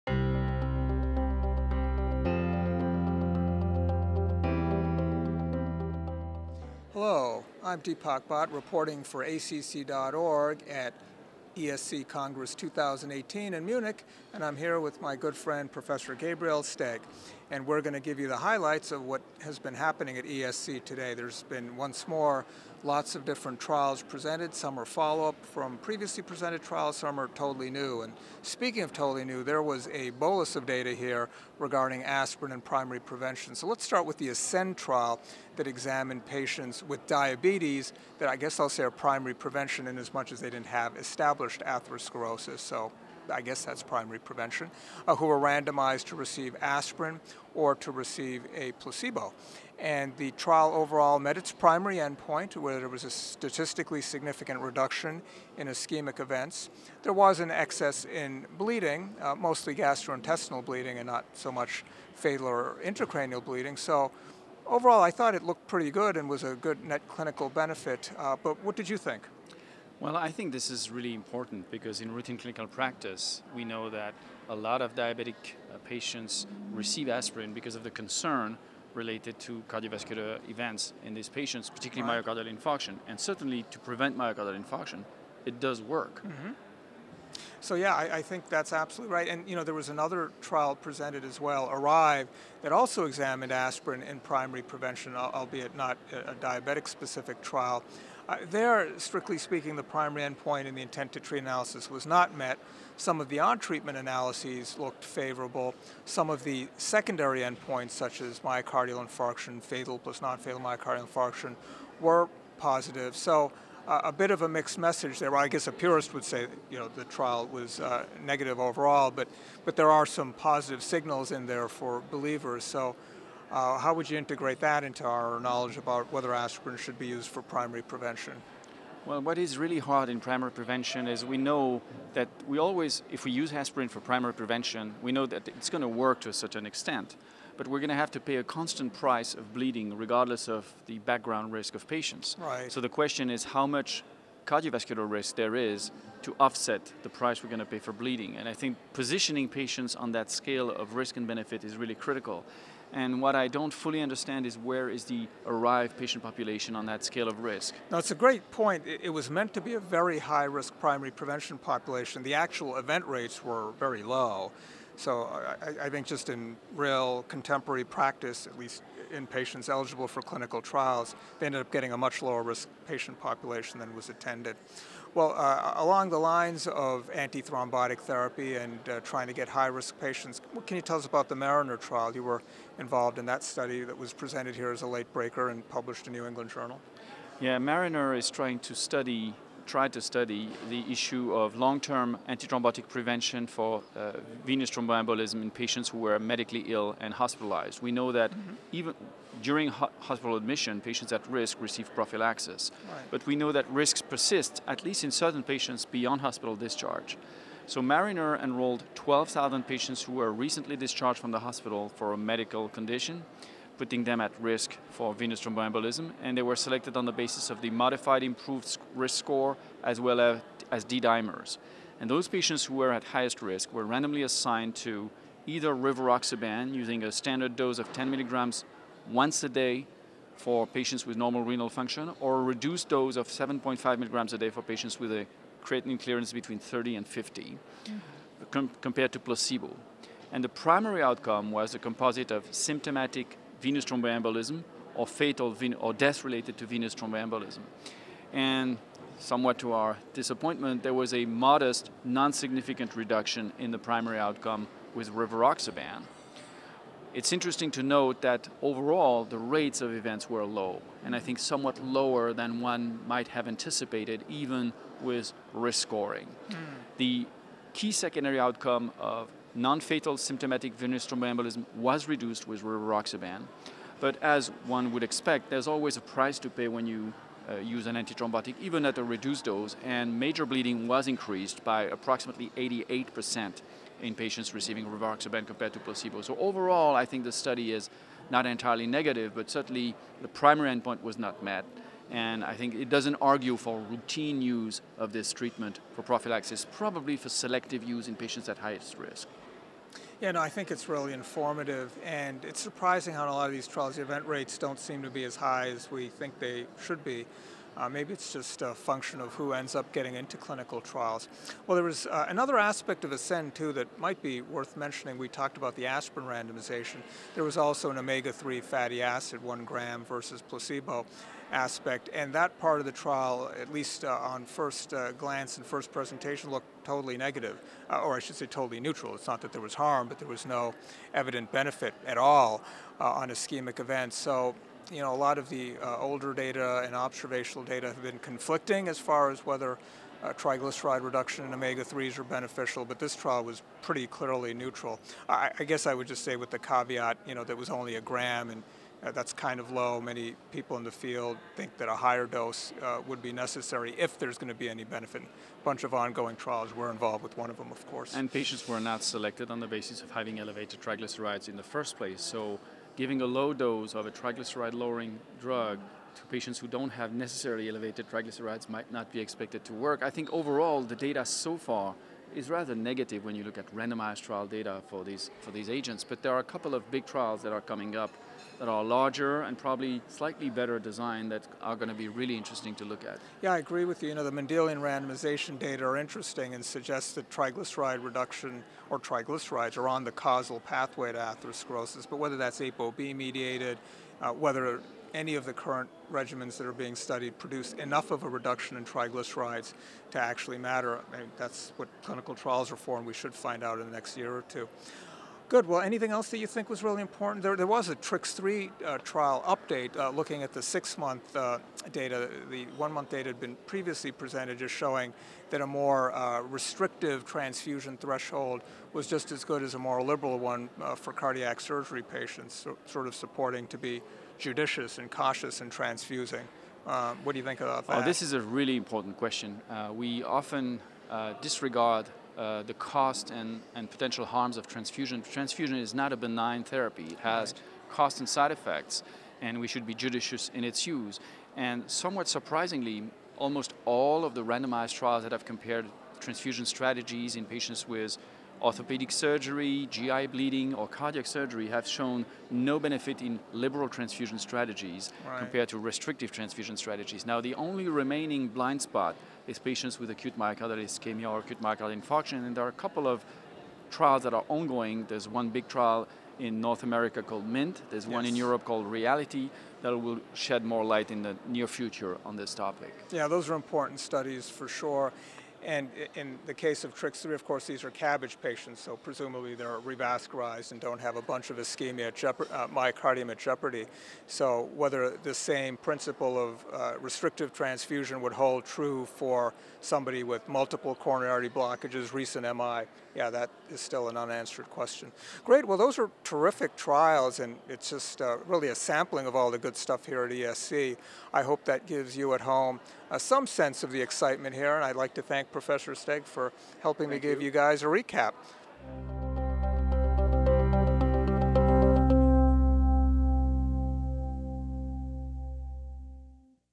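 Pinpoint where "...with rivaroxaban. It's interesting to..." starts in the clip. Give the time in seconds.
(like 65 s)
254 s.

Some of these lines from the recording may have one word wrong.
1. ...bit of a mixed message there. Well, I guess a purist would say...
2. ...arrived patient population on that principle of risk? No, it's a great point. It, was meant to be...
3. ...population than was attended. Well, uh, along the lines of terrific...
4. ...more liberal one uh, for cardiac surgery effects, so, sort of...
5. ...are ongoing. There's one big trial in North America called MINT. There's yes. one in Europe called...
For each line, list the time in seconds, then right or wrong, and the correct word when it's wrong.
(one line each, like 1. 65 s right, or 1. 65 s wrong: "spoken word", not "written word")
1. 114 s right
2. 155 s wrong: "scale", not "principle"
3. 173 s wrong: "antithrombotic", not "terrific"
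4. 419 s wrong: "patients", not "effects"
5. 464 s right.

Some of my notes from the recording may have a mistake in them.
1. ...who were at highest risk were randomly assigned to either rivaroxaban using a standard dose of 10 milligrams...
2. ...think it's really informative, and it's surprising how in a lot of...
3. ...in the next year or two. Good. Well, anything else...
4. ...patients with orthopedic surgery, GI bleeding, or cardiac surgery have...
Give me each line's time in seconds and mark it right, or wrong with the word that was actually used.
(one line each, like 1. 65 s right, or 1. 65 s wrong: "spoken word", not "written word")
1. 222 s right
2. 300 s right
3. 403 s right
4. 447 s right.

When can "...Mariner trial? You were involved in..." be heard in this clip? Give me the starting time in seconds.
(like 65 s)
181 s.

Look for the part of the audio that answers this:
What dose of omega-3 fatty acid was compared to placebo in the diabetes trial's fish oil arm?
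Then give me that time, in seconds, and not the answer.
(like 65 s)
319 s.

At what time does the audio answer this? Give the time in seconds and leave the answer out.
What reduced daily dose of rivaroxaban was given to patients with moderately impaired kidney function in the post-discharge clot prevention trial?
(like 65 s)
233 s.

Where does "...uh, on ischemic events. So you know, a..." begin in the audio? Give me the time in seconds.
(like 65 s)
333 s.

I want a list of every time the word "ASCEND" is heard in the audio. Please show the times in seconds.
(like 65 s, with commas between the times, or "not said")
34 s, 313 s.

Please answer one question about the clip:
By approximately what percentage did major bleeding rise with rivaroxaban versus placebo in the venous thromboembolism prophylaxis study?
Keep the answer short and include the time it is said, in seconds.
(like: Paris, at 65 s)
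88%, at 282 s.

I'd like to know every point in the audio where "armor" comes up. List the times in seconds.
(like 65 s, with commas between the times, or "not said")
not said.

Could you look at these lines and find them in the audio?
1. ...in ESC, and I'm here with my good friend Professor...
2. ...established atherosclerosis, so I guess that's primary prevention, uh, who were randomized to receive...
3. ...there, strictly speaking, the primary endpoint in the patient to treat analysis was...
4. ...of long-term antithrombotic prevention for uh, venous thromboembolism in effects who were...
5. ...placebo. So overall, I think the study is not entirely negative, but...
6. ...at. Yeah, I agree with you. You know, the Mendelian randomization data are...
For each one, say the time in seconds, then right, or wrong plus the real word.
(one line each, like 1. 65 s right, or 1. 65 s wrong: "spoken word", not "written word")
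1. 13 s wrong: "Munich", not "ESC"
2. 41 s right
3. 98 s wrong: "intent", not "patient"
4. 191 s wrong: "patients", not "effects"
5. 285 s right
6. 383 s right.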